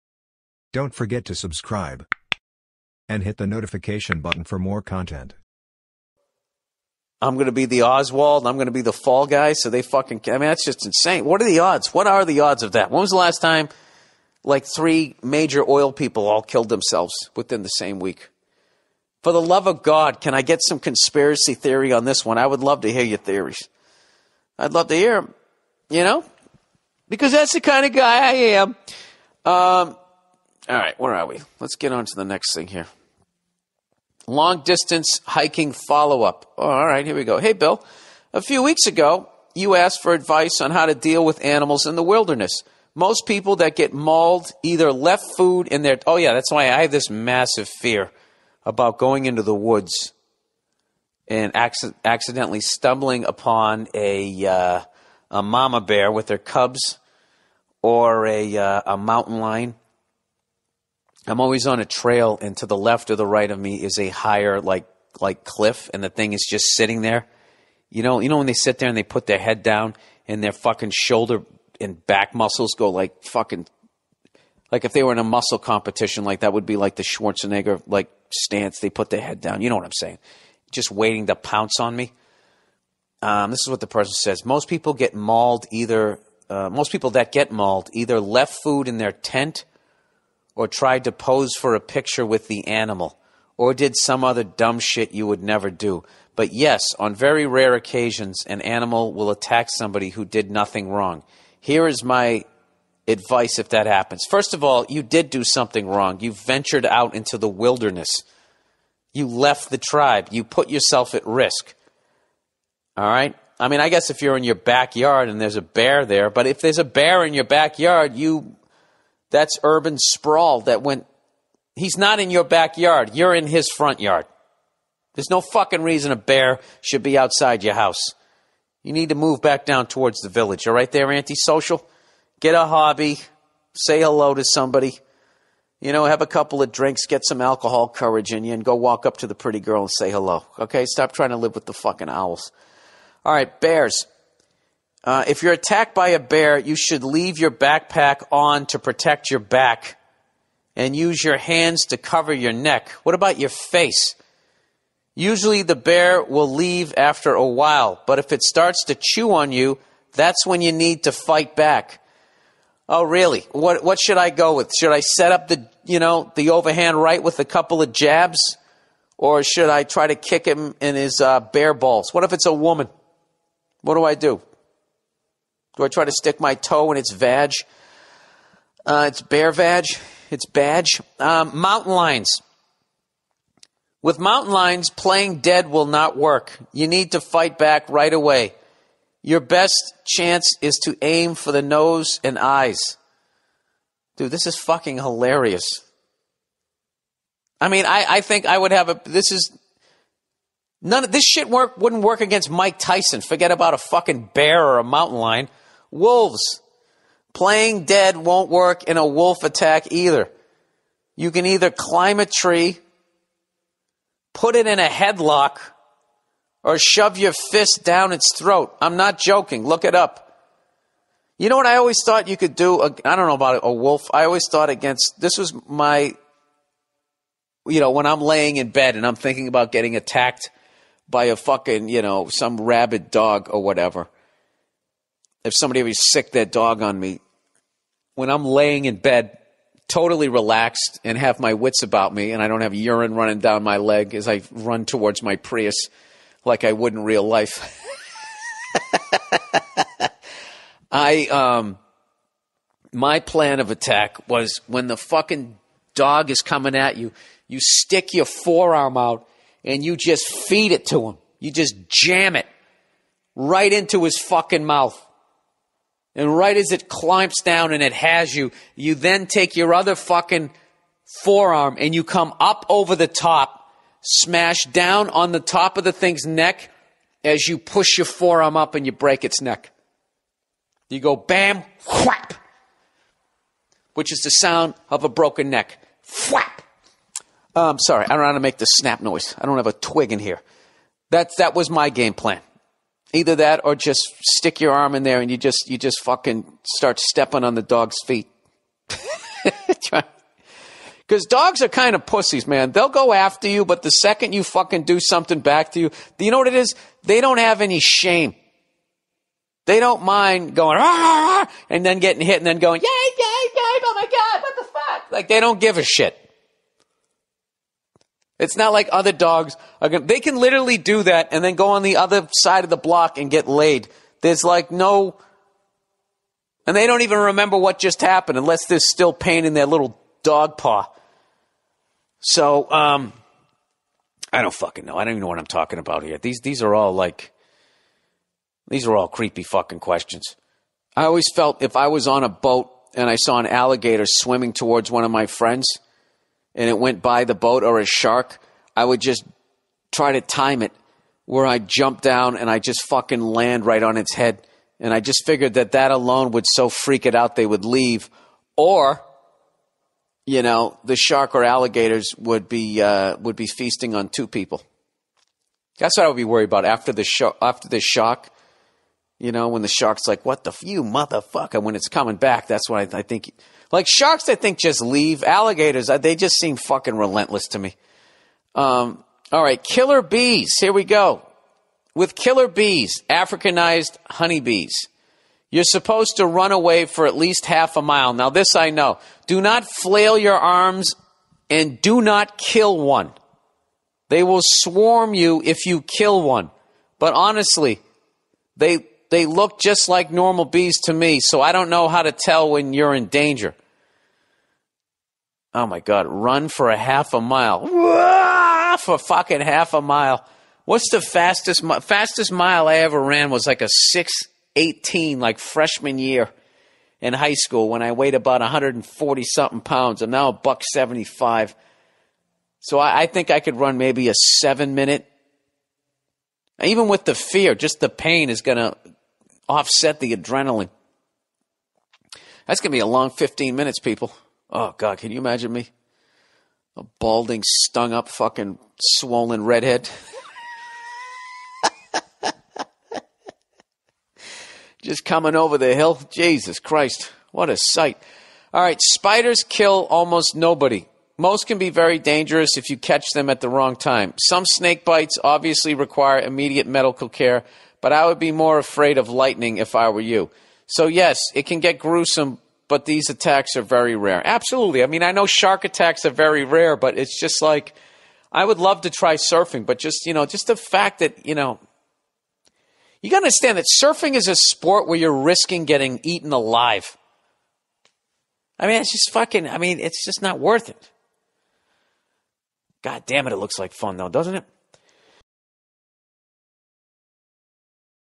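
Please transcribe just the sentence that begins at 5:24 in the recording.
There's like no and they don't even remember what just happened unless there's still pain in their little dog paw.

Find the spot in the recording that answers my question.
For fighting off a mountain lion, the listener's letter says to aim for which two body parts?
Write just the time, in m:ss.
3:11.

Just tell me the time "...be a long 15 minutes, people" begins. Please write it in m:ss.
7:12.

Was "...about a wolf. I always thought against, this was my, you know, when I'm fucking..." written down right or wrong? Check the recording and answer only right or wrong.
wrong.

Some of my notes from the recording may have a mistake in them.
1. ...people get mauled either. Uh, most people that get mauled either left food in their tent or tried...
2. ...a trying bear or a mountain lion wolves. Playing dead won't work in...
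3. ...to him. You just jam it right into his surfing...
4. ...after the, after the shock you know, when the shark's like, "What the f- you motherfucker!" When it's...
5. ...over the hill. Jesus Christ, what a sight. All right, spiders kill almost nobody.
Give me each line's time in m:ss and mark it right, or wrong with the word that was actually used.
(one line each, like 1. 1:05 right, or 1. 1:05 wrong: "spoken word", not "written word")
1. 1:24 right
2. 3:23 wrong: "fucking", not "trying"
3. 4:20 wrong: "fucking", not "surfing"
4. 6:06 right
5. 7:25 right.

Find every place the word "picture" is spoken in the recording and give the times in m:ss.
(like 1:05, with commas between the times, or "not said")
1:31.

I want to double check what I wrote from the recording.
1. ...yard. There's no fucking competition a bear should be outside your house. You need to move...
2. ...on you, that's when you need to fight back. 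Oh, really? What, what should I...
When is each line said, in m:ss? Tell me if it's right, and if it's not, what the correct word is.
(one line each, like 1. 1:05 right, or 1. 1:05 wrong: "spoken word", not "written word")
1. 2:03 wrong: "reason", not "competition"
2. 2:39 right.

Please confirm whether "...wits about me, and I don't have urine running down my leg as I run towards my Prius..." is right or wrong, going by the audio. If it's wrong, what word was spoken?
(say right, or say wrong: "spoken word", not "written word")
right.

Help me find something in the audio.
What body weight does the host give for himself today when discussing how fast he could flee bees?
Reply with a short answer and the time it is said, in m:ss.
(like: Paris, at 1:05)
175 pounds, at 7:00.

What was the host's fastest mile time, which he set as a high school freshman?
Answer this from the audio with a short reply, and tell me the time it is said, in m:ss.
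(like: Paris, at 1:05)
6:18, at 6:53.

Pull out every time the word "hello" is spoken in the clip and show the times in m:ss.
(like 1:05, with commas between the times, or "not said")
2:14, 2:20.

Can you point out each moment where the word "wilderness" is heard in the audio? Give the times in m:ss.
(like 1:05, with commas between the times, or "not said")
0:42, 1:47.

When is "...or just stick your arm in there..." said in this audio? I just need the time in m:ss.
4:53.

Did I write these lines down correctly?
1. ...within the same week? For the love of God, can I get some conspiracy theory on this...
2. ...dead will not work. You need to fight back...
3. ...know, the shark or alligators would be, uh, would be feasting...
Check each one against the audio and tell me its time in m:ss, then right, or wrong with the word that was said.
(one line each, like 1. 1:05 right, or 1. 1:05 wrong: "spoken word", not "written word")
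1. 0:17 right
2. 3:05 right
3. 6:00 right.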